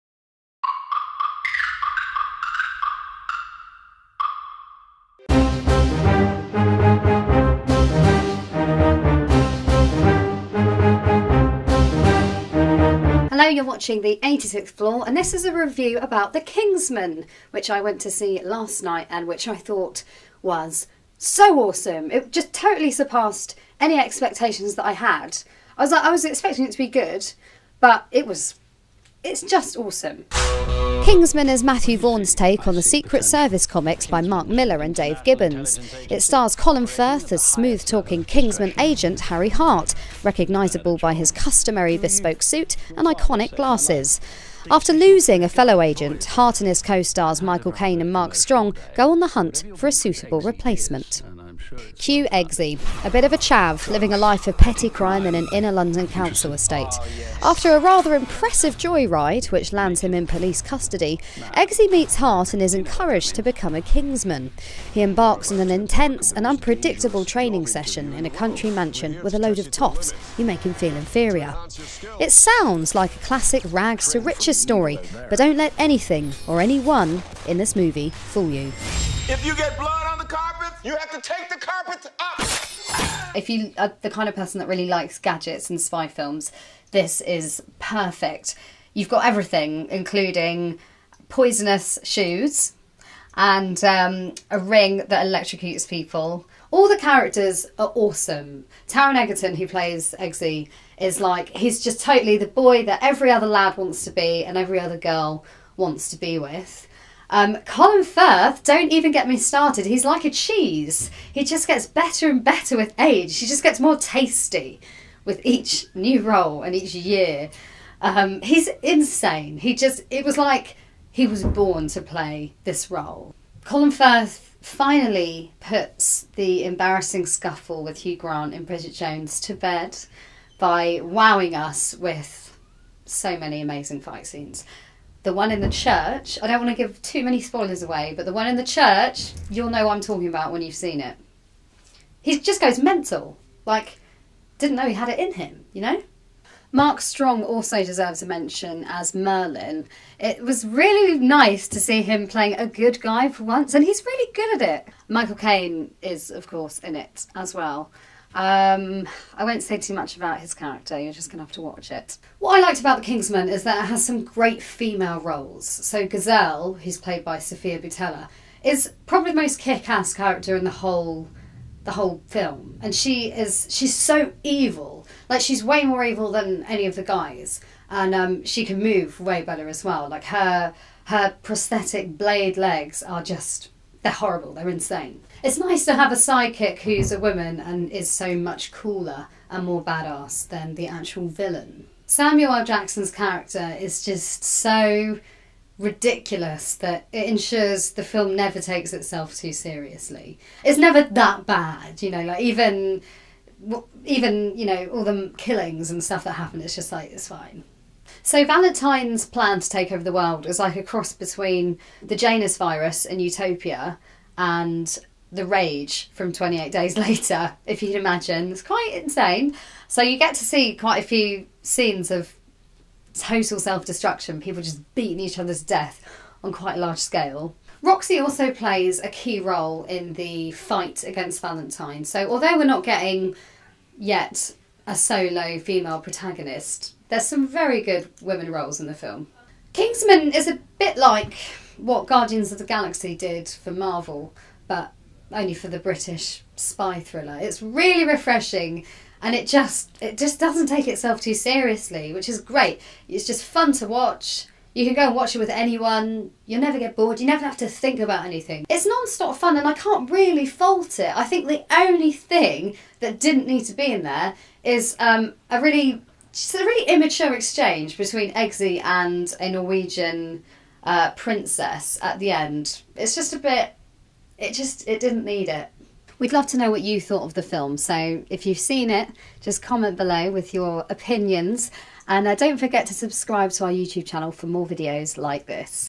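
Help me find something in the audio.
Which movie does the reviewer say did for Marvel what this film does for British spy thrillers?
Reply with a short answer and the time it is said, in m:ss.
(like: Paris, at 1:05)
Guardians of the Galaxy, at 4:02.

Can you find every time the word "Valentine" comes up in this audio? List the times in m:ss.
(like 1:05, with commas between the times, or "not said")
3:28, 3:51.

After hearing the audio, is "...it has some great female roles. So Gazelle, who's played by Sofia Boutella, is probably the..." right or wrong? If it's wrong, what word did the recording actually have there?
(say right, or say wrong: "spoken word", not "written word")
right.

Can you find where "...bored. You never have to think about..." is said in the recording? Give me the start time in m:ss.
4:16.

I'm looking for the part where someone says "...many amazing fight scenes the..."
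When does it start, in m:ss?
2:13.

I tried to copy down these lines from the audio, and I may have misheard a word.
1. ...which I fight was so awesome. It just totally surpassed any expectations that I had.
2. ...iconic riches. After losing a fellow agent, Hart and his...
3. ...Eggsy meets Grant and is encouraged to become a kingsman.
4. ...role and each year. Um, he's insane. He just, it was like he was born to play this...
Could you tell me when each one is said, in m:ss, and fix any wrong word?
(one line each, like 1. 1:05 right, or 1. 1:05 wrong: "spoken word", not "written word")
1. 0:19 wrong: "thought", not "fight"
2. 0:43 wrong: "glasses", not "riches"
3. 1:01 wrong: "Hart", not "Grant"
4. 1:56 right.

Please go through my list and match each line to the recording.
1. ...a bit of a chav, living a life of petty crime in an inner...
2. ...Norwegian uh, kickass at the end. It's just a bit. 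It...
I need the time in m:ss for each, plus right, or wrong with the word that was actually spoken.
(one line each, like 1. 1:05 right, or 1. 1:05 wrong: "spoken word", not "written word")
1. 0:53 right
2. 4:29 wrong: "princess", not "kickass".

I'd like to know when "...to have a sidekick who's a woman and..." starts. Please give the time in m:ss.
3:05.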